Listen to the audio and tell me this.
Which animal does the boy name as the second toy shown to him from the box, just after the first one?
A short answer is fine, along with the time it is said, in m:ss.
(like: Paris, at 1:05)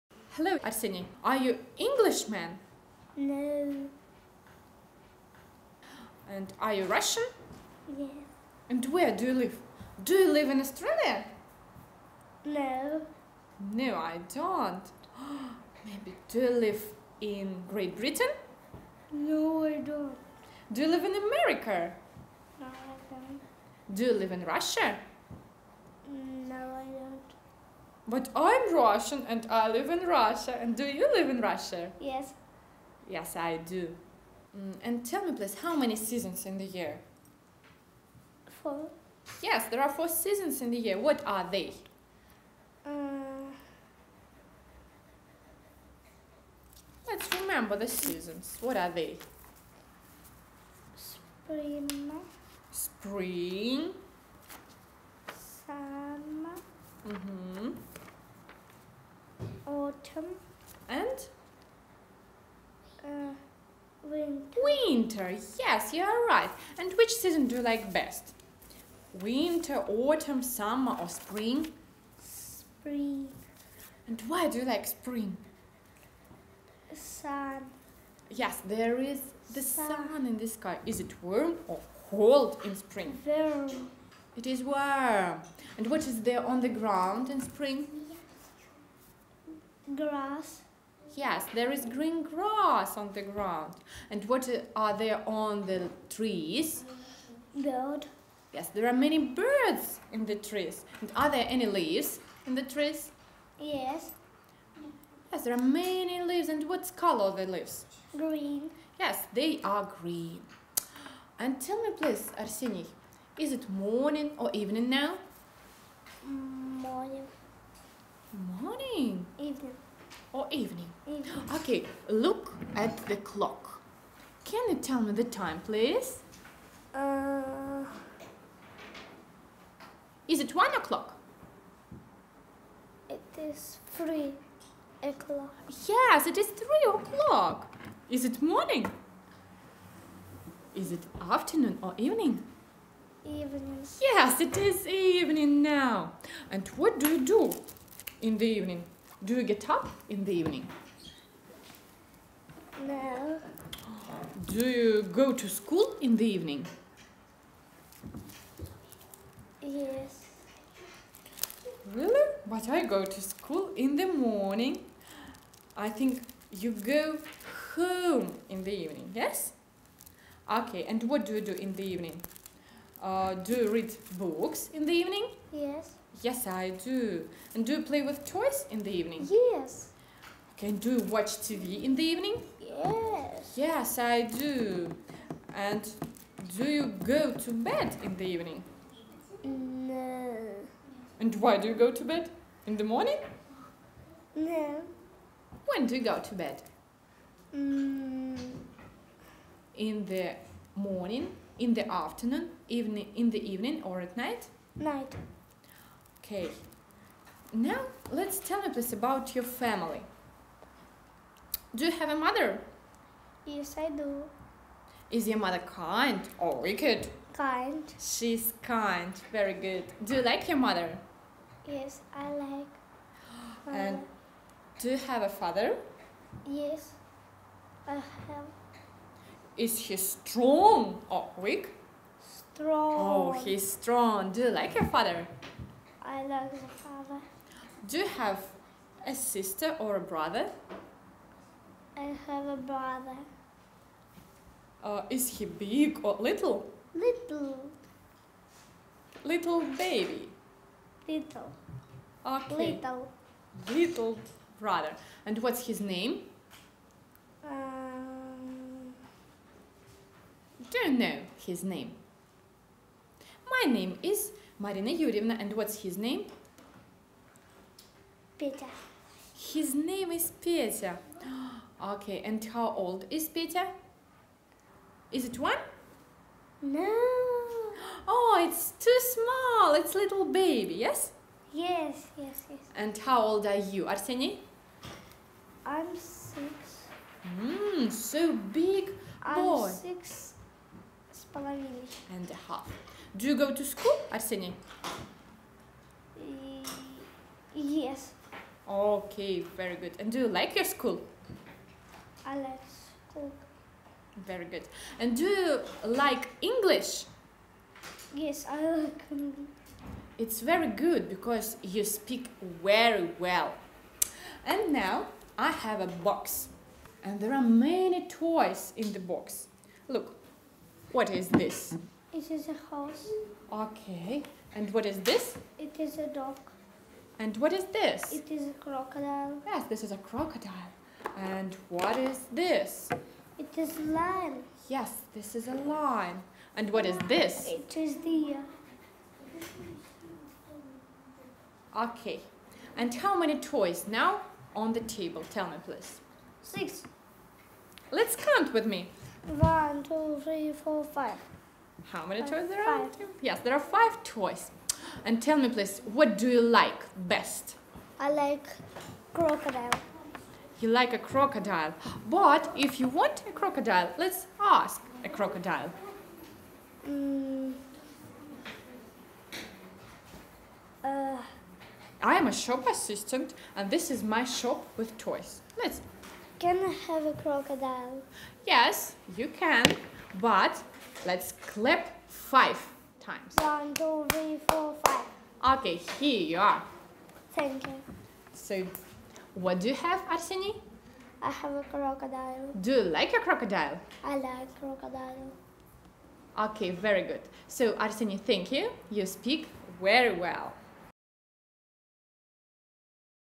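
Dog, at 5:26.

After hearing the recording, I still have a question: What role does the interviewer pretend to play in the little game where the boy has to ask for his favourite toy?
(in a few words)
Shop assistant.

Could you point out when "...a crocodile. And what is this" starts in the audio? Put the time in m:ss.
5:29.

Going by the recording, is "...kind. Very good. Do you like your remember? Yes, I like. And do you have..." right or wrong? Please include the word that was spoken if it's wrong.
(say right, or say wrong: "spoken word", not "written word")
wrong: "mother", not "remember".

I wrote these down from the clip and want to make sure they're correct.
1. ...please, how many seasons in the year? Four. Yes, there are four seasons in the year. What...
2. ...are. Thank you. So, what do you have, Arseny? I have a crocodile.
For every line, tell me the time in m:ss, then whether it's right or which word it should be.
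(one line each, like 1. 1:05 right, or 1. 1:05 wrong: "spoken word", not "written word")
1. 0:35 right
2. 6:26 right.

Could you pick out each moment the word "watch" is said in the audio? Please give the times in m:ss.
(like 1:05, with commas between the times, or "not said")
3:01.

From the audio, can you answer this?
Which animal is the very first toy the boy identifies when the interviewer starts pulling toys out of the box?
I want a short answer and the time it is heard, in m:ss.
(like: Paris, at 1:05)
Horse, at 5:22.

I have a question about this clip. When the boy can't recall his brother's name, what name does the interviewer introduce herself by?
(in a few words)
Marina Yurievna.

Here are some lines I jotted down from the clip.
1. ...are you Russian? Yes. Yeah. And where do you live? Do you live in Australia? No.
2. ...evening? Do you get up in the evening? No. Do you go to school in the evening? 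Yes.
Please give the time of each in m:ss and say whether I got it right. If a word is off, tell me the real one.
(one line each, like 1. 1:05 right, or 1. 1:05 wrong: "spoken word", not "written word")
1. 0:06 right
2. 2:28 right.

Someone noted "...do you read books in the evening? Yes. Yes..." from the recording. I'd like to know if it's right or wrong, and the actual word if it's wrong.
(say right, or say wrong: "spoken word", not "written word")
right.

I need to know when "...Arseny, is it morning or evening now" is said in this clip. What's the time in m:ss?
1:52.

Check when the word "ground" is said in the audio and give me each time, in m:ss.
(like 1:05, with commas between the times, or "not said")
1:26, 1:33.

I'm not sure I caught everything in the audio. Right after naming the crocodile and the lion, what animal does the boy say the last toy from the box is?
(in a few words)
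Deer.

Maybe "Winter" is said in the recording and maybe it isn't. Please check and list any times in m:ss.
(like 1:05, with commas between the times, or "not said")
1:04, 1:09.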